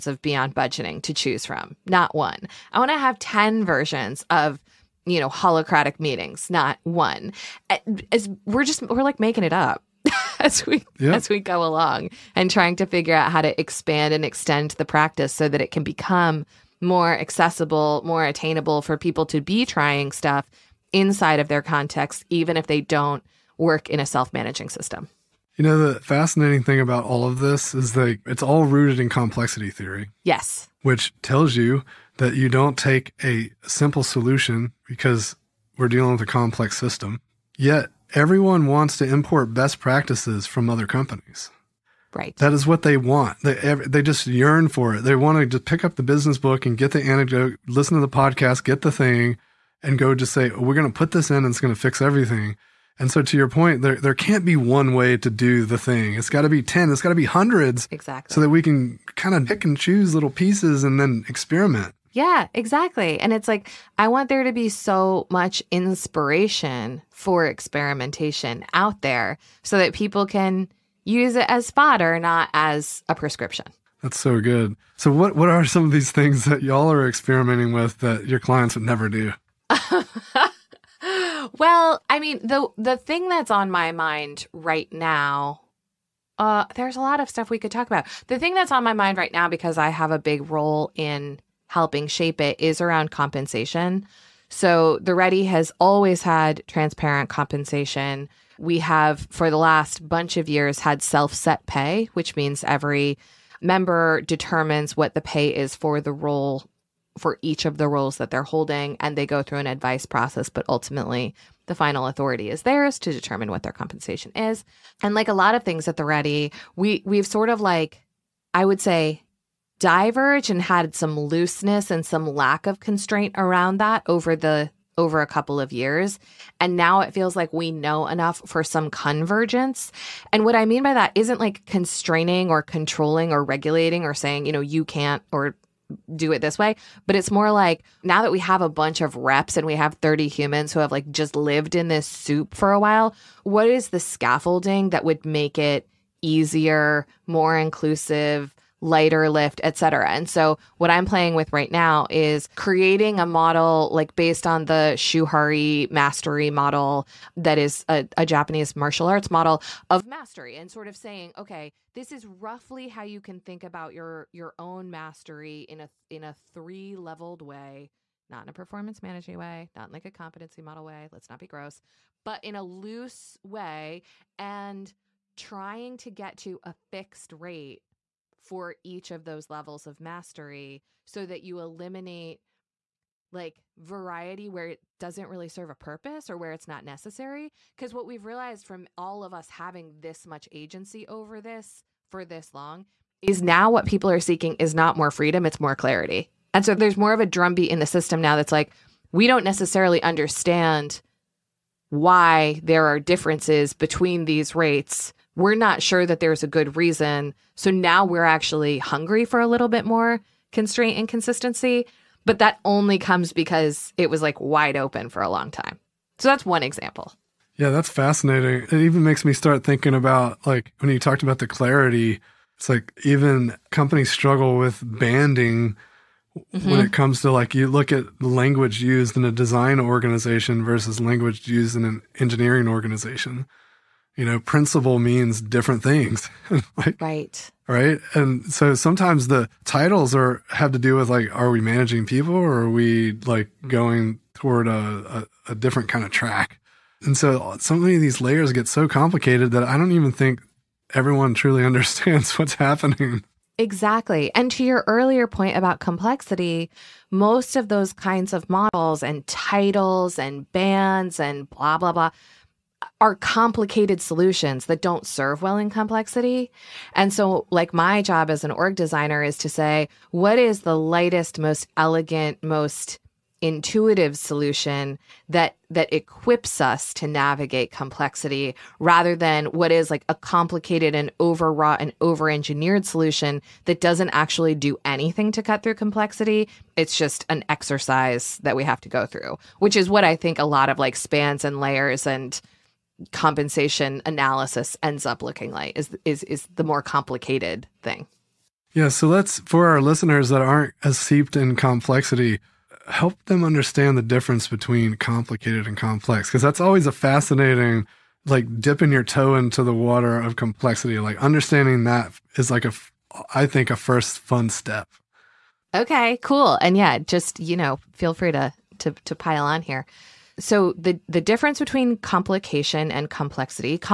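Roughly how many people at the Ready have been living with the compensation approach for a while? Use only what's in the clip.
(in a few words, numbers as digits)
30.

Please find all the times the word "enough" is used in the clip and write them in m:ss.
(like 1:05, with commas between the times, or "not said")
2:08.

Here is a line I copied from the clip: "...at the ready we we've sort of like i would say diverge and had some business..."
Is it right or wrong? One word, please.
wrong.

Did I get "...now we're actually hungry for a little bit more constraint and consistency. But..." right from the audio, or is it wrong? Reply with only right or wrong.
right.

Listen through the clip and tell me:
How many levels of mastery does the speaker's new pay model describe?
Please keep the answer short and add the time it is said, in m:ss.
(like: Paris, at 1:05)
3, at 2:46.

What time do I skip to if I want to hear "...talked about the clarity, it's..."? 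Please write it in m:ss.
3:40.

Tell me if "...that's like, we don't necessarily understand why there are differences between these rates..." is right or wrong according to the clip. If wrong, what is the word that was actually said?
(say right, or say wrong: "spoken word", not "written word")
right.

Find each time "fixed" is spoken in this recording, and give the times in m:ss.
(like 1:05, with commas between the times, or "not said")
2:56.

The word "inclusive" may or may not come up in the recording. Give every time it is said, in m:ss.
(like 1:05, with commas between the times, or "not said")
2:27.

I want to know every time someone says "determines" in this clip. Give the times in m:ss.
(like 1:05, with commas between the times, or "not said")
1:44, 1:53.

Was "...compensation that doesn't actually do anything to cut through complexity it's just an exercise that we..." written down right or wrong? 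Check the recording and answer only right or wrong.
wrong.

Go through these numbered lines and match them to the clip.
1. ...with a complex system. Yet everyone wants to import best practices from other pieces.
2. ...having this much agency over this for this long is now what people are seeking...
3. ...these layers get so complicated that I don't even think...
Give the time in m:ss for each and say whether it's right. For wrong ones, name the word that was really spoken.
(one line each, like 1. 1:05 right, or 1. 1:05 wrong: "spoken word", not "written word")
1. 0:36 wrong: "companies", not "pieces"
2. 3:09 right
3. 4:08 right.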